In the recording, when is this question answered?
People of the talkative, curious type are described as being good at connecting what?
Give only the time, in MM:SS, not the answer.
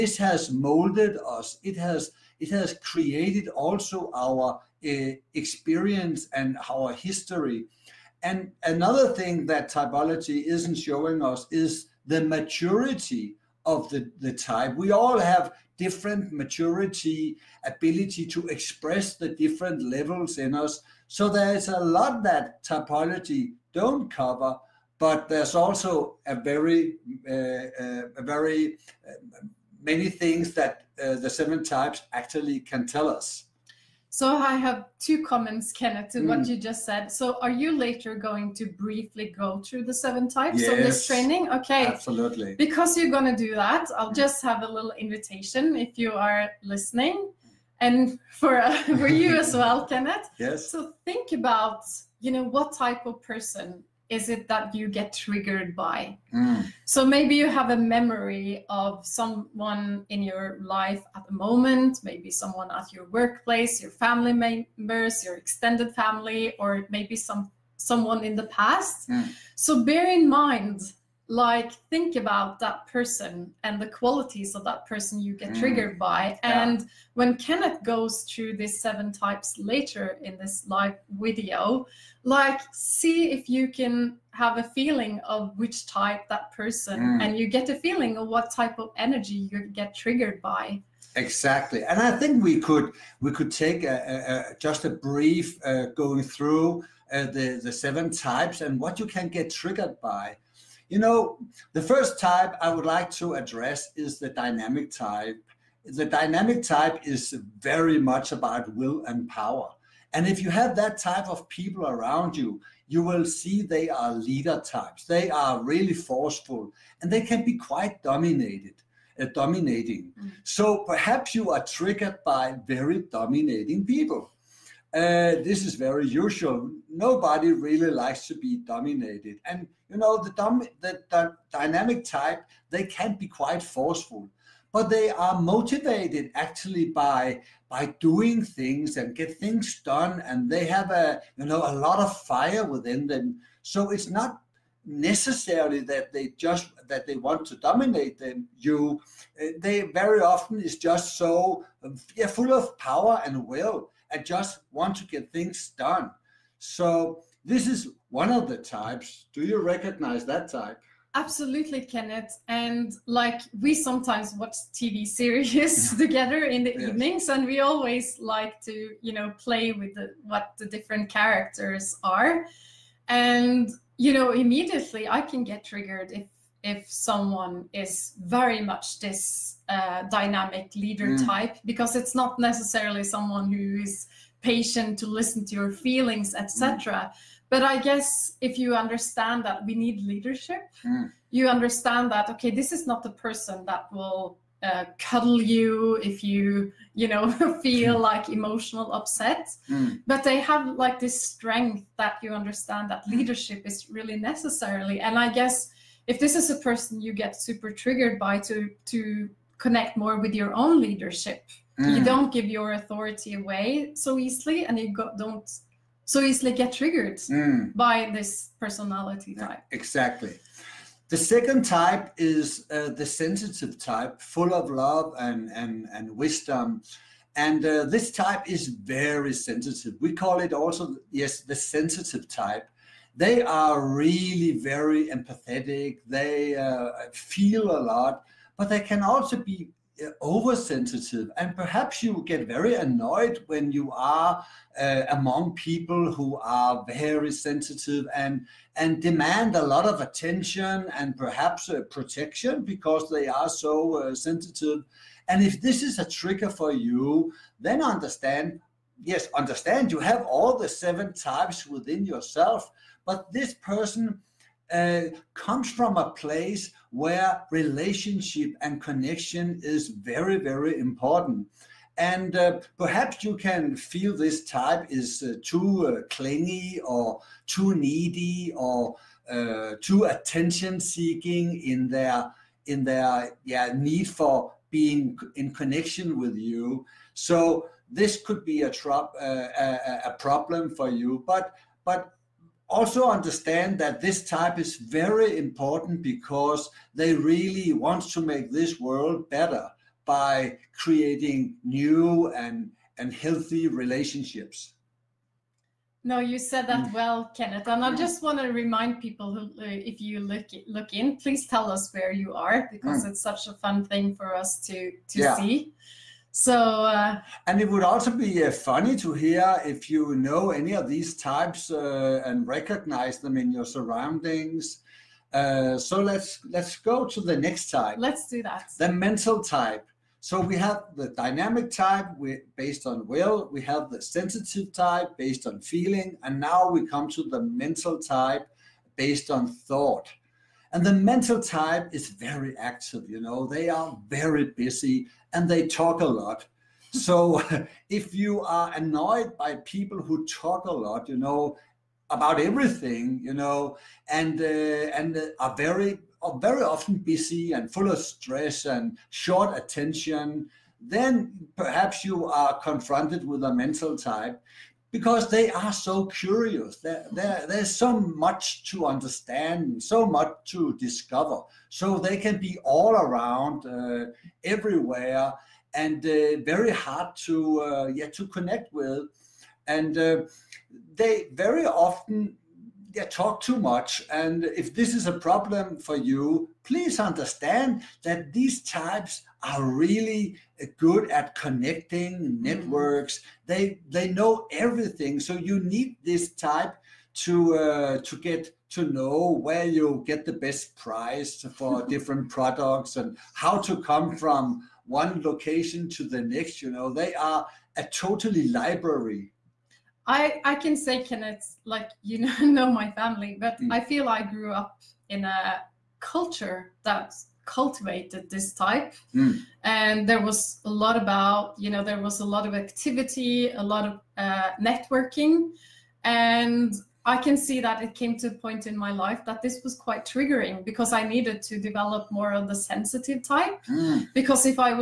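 06:32.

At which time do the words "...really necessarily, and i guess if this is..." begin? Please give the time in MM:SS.
03:23.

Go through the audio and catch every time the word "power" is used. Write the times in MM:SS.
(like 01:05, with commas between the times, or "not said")
01:49, 02:32.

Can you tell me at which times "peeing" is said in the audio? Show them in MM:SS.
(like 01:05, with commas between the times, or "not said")
not said.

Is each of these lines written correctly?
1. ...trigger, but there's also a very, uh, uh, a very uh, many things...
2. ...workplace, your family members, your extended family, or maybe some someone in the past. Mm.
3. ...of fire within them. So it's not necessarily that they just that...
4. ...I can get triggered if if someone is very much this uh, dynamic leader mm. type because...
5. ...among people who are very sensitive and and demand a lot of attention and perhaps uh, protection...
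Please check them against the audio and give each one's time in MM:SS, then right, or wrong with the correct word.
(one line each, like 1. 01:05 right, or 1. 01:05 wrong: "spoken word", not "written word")
1. 00:24 wrong: "cover", not "trigger"
2. 01:03 right
3. 02:21 right
4. 02:55 right
5. 04:05 right.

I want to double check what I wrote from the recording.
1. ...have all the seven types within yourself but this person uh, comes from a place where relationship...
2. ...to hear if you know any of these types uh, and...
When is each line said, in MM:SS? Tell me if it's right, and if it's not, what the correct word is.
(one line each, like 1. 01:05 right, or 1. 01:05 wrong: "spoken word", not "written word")
1. 04:19 right
2. 05:18 right.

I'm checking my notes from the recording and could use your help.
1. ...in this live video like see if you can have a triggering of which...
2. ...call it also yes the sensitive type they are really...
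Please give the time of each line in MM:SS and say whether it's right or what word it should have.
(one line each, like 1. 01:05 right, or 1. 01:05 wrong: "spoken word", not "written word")
1. 01:20 wrong: "feeling", not "triggering"
2. 03:50 right.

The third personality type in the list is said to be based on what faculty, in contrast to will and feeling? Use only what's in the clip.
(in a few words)
Thought.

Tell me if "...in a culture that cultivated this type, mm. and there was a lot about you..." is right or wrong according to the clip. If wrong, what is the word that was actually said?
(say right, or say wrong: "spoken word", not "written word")
right.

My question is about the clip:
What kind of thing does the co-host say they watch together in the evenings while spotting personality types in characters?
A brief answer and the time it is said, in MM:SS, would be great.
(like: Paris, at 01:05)
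TV series, at 02:44.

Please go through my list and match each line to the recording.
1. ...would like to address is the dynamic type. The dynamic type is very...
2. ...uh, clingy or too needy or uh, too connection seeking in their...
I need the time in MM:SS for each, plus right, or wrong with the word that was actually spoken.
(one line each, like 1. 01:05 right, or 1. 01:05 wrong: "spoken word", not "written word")
1. 01:42 right
2. 04:35 wrong: "attention", not "connection".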